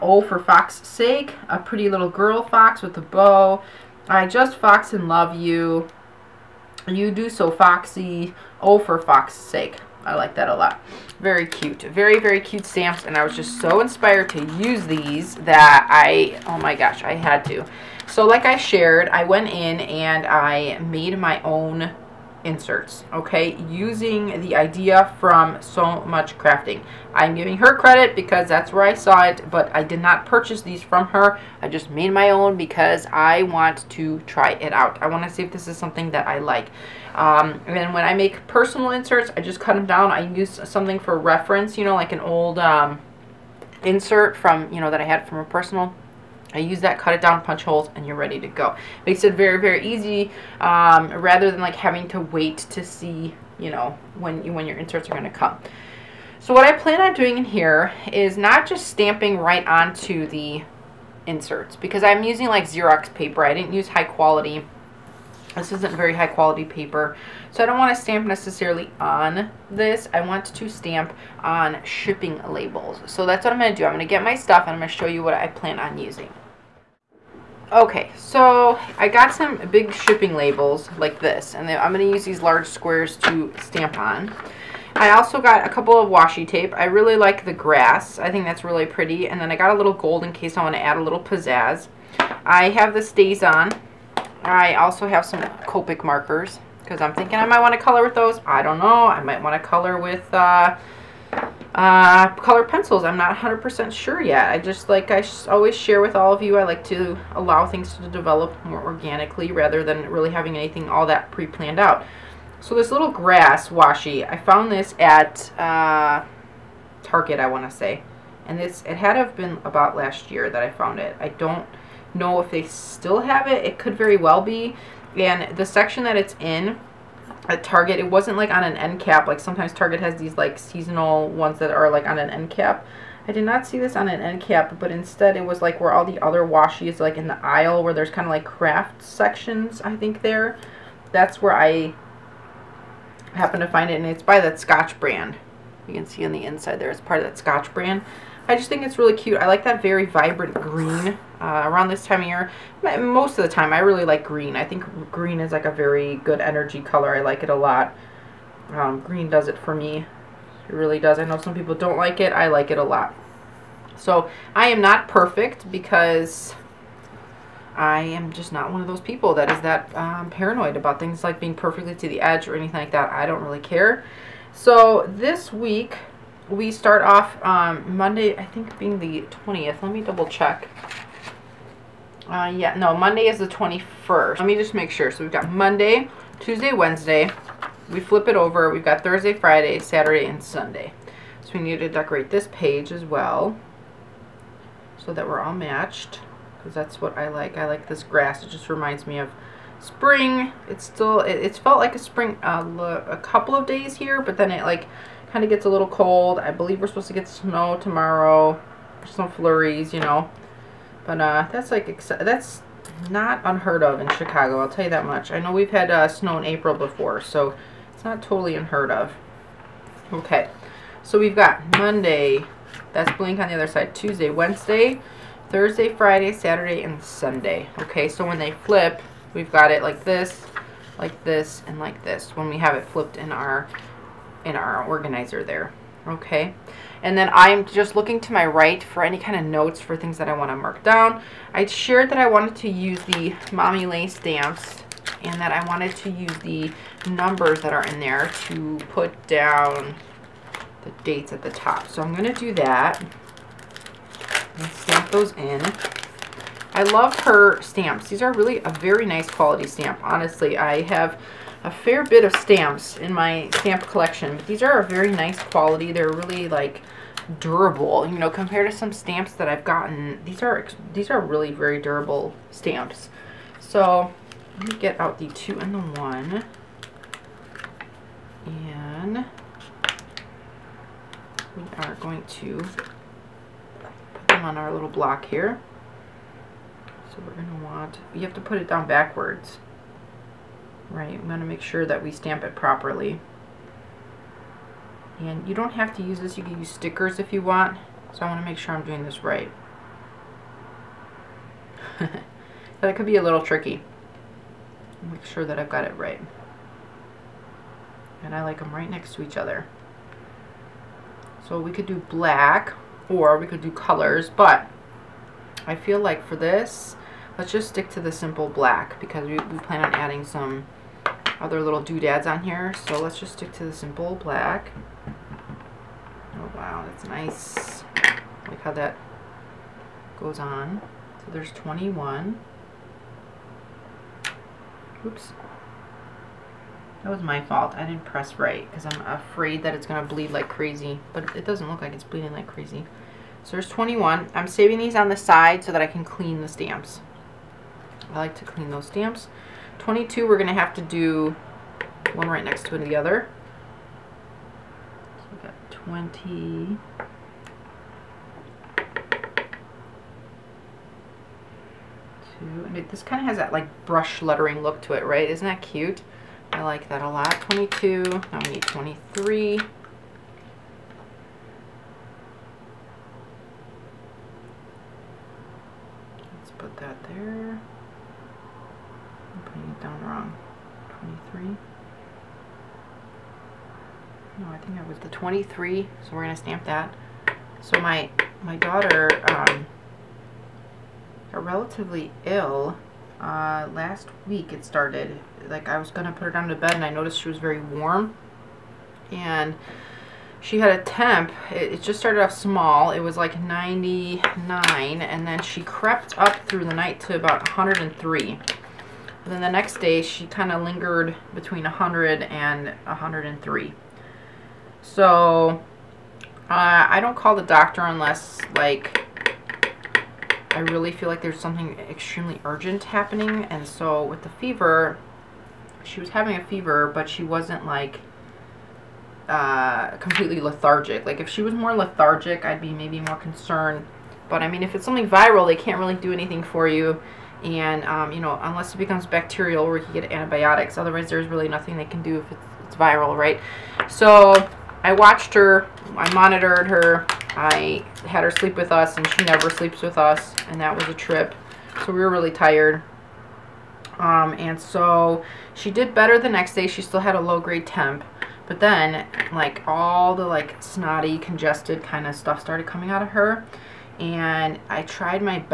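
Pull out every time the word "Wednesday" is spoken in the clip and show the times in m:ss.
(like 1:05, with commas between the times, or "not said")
3:06, 3:44.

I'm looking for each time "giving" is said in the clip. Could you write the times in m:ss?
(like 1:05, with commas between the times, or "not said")
0:27.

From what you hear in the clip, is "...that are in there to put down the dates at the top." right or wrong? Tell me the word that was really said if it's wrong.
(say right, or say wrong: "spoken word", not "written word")
right.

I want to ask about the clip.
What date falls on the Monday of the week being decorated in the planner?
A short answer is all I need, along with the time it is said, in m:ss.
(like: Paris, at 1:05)
21st, at 3:02.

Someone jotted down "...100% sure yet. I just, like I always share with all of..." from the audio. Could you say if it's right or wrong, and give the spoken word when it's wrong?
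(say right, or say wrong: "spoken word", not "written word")
right.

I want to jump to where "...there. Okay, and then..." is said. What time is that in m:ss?
3:55.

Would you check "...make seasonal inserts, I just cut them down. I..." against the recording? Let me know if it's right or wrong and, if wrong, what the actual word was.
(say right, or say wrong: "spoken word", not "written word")
wrong: "personal", not "seasonal".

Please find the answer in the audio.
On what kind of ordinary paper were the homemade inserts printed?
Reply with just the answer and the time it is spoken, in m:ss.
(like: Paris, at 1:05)
Xerox paper, at 1:02.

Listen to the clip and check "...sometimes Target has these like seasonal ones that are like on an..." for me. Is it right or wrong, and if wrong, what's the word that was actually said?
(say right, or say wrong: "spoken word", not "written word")
right.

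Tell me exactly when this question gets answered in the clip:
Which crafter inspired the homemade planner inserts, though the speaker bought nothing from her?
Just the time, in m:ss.
0:25.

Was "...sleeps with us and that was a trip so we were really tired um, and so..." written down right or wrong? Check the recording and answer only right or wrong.
right.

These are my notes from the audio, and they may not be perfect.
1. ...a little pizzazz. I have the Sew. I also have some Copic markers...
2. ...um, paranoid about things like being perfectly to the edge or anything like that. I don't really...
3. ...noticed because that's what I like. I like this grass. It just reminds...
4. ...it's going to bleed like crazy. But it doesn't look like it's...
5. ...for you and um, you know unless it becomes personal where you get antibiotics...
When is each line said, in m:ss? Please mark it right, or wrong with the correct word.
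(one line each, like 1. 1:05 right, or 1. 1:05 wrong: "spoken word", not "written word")
1. 1:30 wrong: "StazOn", not "Sew"
2. 2:49 right
3. 3:15 wrong: "matched", not "noticed"
4. 5:39 right
5. 7:16 wrong: "bacterial", not "personal".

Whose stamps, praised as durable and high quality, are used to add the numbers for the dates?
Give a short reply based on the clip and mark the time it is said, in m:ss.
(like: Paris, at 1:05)
Mommy Lhey, at 4:03.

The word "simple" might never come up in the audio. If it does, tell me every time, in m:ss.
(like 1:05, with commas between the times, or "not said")
5:18, 5:23.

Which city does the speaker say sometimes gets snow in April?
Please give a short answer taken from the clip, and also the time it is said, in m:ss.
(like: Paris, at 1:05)
Chicago, at 3:34.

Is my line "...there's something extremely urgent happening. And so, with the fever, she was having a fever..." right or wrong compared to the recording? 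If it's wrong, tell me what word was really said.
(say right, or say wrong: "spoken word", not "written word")
right.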